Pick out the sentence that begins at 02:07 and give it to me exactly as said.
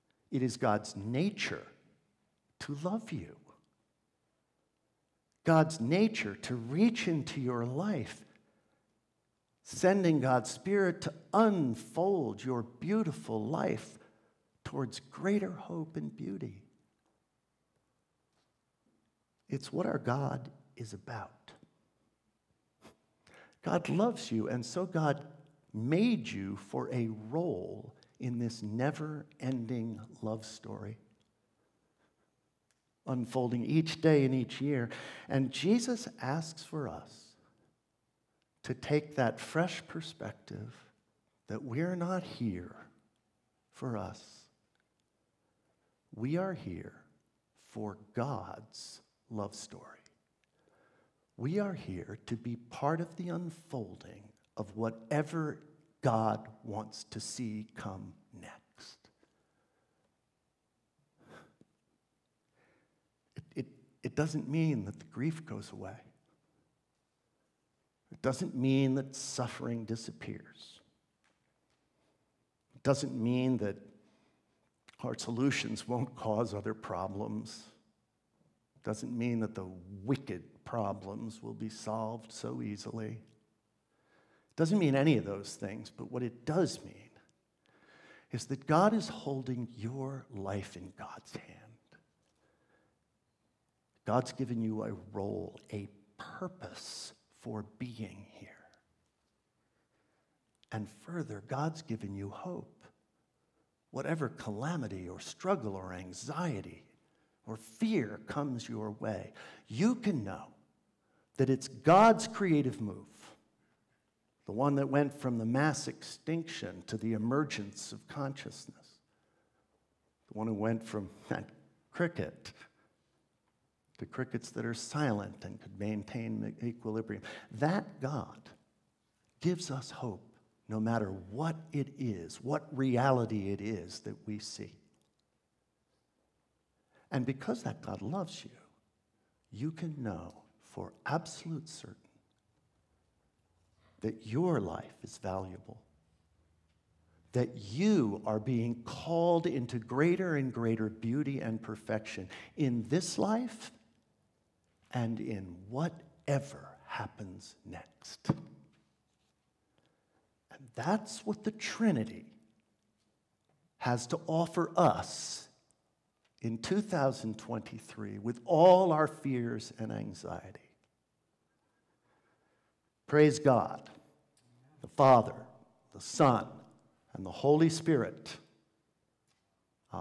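That God gives us hope no matter what it is, what reality it is that we see.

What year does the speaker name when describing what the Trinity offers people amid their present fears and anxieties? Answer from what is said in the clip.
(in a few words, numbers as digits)
2023.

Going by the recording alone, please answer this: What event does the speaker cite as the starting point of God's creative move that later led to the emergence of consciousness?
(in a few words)
mass extinction.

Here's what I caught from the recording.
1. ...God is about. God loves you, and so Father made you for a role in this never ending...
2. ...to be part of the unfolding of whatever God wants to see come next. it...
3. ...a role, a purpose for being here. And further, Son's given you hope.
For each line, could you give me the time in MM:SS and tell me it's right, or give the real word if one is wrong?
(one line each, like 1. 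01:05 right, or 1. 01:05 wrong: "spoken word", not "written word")
1. 00:19 wrong: "God", not "Father"
2. 00:52 right
3. 01:34 wrong: "God", not "Son".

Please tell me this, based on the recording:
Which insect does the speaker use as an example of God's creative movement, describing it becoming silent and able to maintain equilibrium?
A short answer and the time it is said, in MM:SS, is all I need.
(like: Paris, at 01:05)
cricket, at 02:01.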